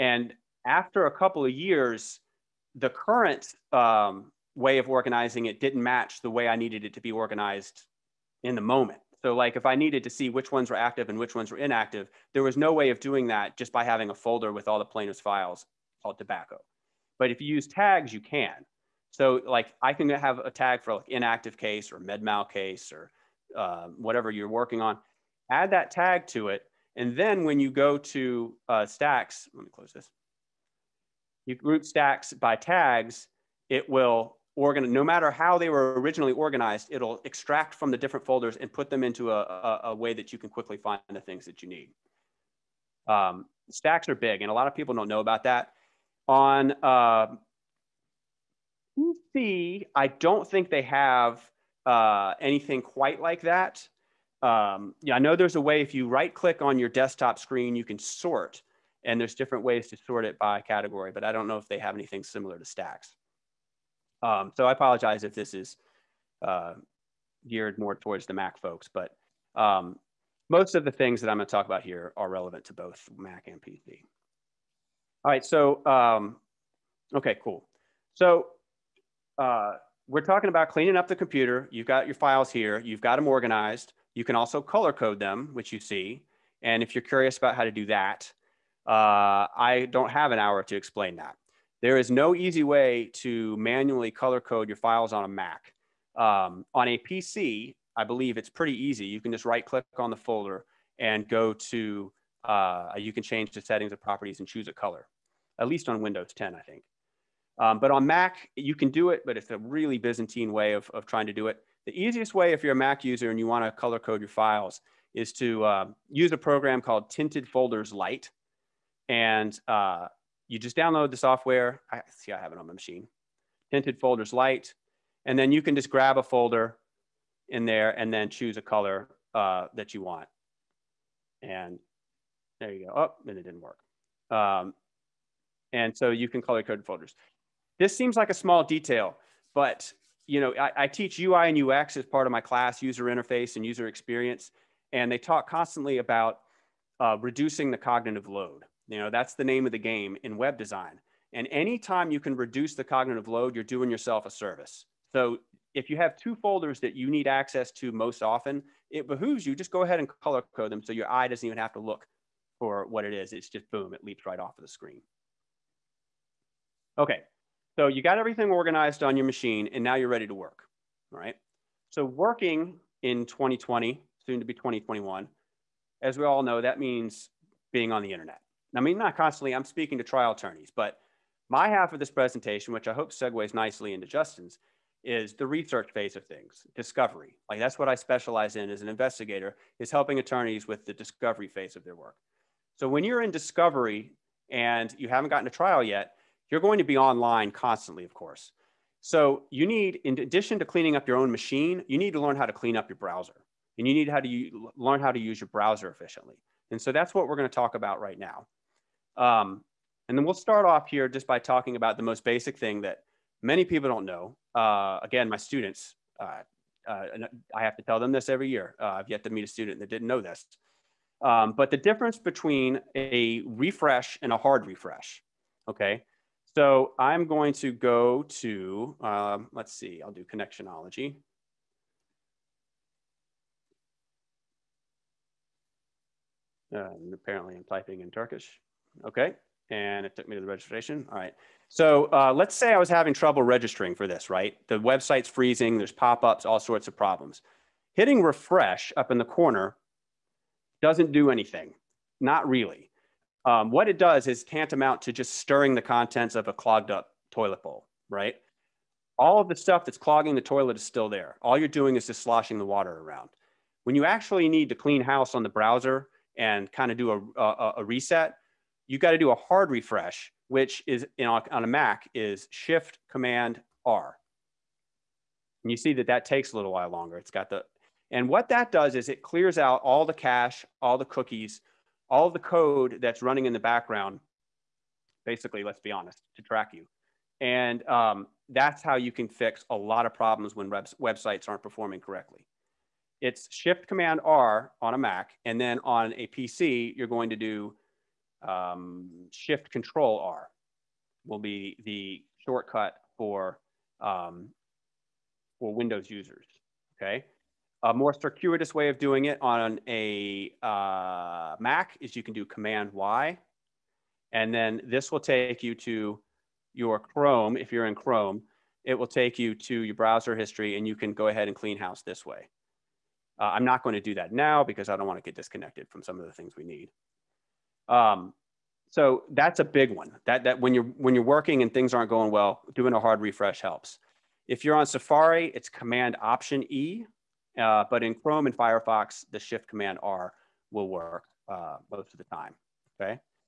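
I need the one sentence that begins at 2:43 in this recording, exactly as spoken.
It's just boom, it leaps right off of the screen.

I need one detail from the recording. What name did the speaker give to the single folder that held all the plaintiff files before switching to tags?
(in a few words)
tobacco.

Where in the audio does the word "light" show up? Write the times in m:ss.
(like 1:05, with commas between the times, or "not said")
1:57, 2:04.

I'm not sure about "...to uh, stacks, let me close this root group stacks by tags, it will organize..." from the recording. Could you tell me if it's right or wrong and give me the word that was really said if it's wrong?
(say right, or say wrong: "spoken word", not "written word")
right.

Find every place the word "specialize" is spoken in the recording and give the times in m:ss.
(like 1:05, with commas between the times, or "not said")
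3:07.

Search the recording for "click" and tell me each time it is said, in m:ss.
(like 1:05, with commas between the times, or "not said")
0:56, 1:39.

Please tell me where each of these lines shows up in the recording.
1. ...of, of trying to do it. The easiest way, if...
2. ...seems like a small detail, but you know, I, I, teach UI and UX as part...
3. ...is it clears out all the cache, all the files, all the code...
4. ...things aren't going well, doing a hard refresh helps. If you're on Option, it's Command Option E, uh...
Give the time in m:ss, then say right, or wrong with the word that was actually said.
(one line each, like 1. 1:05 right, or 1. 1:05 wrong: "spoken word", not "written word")
1. 1:50 right
2. 2:17 right
3. 4:38 wrong: "cookies", not "files"
4. 5:31 wrong: "Safari", not "Option".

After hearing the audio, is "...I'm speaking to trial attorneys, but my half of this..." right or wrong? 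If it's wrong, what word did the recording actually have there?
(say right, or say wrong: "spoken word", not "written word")
right.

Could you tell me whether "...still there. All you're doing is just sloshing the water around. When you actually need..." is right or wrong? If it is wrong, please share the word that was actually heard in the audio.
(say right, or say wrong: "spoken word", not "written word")
right.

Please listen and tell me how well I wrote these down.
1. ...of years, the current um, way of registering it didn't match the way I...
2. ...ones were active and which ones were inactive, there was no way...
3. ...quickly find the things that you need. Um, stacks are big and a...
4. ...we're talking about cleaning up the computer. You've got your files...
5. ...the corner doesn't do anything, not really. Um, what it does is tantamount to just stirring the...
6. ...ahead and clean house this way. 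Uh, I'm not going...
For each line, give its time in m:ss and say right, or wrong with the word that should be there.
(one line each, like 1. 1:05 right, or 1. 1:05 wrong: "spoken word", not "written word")
1. 0:01 wrong: "organizing", not "registering"
2. 0:10 right
3. 0:40 right
4. 1:20 right
5. 4:09 right
6. 5:21 right.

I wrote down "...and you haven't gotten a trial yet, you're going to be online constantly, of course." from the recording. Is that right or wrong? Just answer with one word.
right.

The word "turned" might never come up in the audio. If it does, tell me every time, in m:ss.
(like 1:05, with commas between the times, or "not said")
not said.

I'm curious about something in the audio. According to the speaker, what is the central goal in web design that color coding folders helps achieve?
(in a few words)
reducing the cognitive load.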